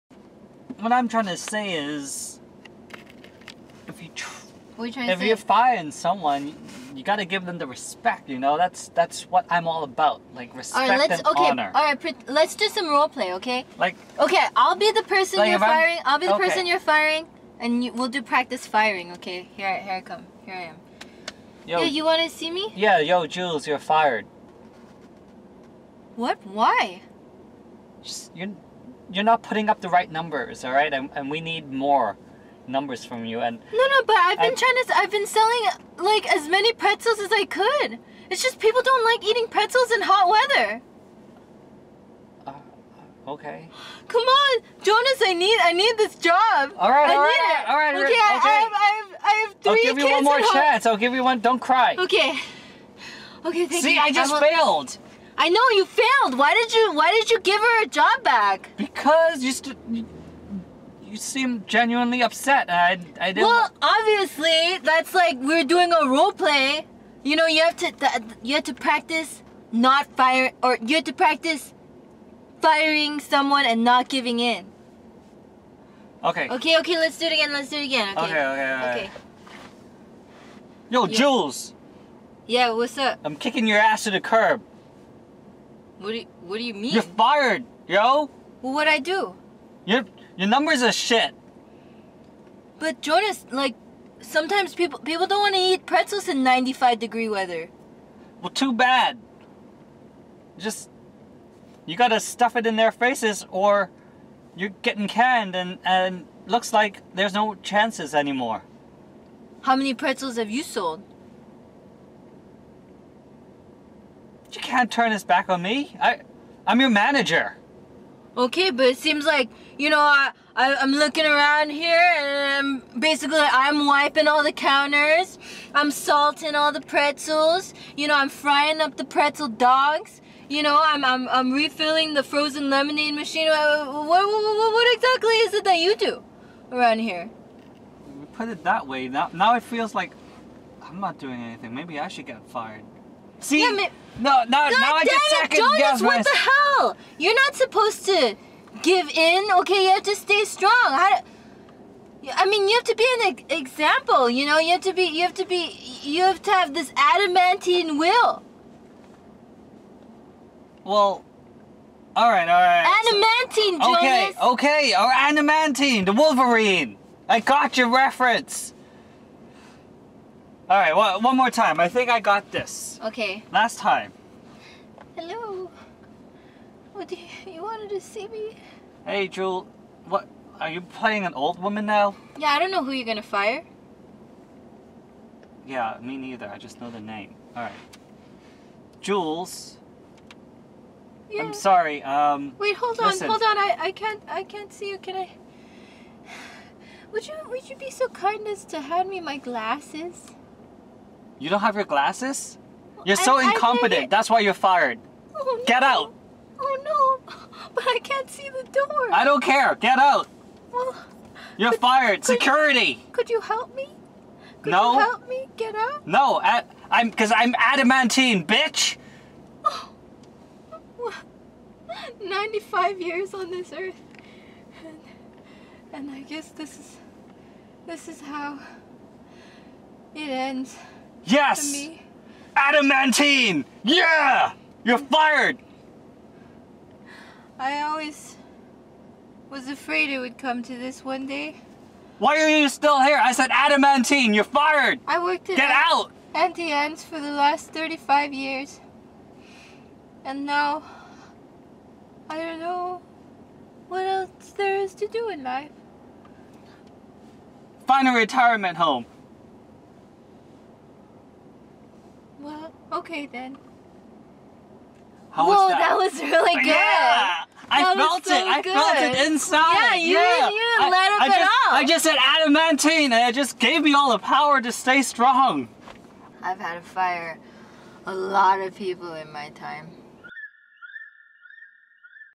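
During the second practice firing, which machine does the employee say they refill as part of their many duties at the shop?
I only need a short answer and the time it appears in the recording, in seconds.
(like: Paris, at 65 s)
frozen lemonade machine, at 132 s.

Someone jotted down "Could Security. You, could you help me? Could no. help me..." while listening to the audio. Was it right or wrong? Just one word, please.
right.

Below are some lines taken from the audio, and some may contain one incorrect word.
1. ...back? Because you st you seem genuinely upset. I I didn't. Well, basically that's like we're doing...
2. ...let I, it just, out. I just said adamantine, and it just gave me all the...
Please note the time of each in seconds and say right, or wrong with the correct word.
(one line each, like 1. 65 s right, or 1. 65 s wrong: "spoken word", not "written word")
1. 58 s wrong: "obviously", not "basically"
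2. 270 s right.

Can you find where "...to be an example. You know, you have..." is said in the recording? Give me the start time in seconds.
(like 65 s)
152 s.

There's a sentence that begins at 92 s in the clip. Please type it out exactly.
But Jonas, like, sometimes people people don't want to eat pretzels in 95 degree weather.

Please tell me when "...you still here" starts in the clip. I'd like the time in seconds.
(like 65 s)
242 s.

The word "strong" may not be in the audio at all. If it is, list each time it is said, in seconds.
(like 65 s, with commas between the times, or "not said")
150 s, 275 s.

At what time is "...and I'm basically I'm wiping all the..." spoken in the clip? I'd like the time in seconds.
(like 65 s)
122 s.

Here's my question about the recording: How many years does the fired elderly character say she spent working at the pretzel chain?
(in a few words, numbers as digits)
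35.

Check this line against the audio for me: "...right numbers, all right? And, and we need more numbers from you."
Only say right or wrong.
right.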